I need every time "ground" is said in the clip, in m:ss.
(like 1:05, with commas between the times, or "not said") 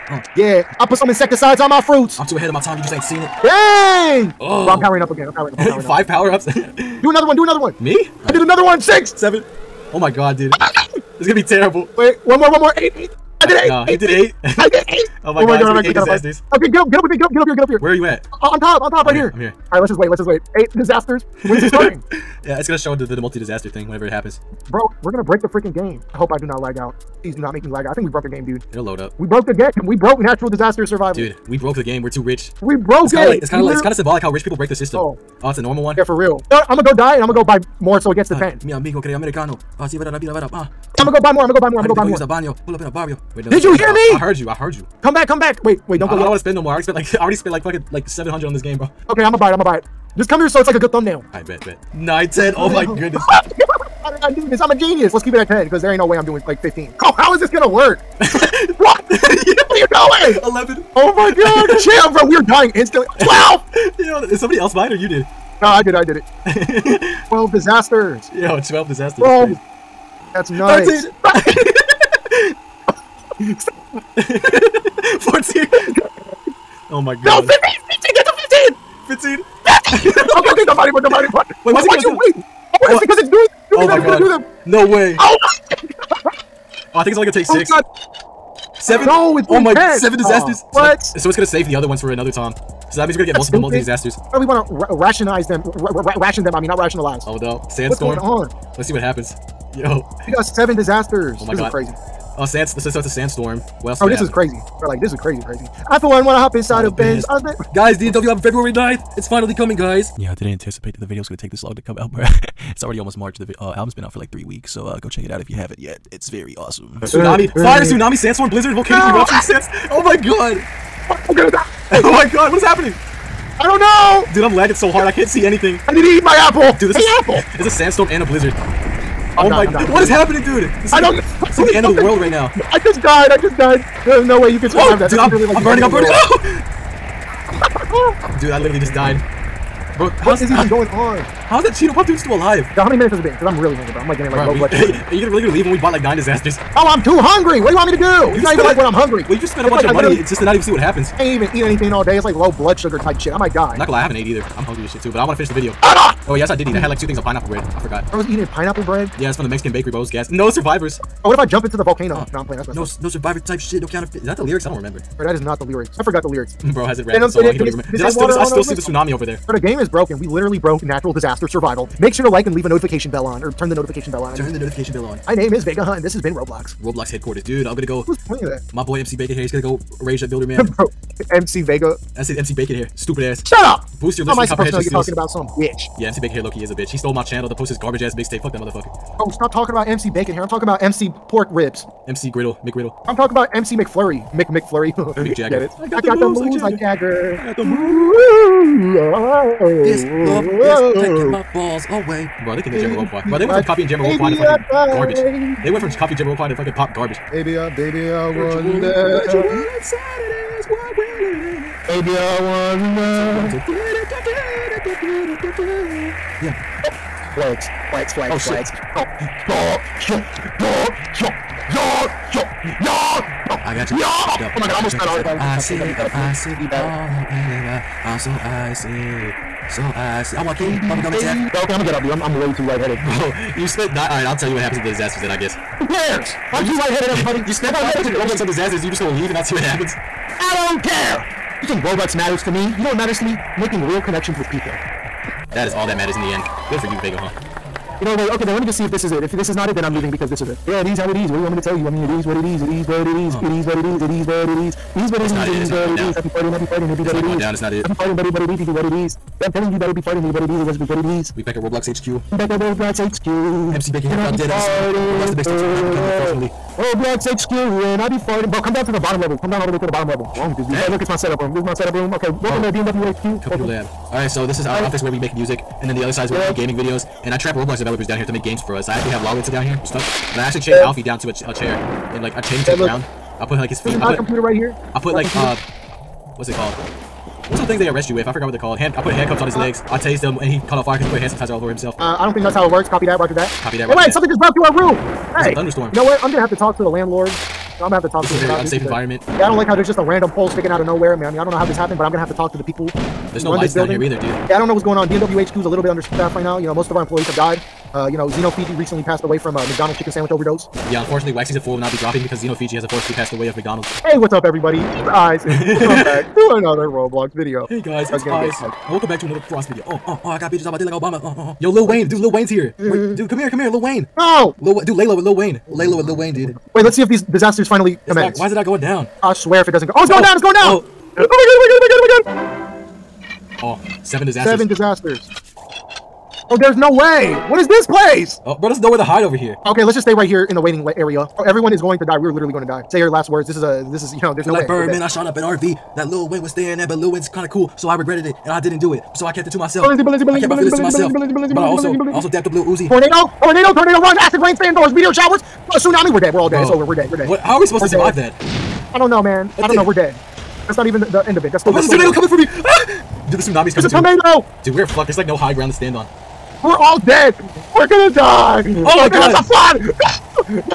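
4:42, 6:05.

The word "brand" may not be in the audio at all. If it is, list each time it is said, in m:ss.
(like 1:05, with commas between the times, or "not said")
not said.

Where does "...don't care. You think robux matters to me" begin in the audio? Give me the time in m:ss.
4:00.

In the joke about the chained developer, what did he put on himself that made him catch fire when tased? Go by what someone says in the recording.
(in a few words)
hand sanitizer.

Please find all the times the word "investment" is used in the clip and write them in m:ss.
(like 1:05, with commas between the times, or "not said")
not said.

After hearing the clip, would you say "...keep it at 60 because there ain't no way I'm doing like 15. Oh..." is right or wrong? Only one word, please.
wrong.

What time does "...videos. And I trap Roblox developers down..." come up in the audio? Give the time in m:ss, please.
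4:36.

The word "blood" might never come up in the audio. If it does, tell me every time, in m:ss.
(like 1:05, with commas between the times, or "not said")
2:24, 2:32.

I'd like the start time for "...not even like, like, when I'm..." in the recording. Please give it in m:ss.
2:28.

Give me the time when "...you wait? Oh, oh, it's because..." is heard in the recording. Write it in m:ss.
1:22.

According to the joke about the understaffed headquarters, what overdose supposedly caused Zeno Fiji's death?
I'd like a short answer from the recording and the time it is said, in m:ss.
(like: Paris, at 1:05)
McDonald's chicken sandwich, at 5:09.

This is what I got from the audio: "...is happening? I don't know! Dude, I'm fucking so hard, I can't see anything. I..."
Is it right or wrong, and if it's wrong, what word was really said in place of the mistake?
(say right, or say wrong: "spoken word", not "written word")
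wrong: "lagging", not "fucking".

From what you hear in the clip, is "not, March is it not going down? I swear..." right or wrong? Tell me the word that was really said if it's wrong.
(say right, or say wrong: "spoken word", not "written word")
wrong: "Why", not "March".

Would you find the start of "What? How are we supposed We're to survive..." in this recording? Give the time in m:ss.
5:57.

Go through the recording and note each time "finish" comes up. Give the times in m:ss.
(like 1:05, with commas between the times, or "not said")
2:35.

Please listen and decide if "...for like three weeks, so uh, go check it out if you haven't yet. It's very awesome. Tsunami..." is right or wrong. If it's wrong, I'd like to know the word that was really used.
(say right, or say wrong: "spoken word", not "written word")
right.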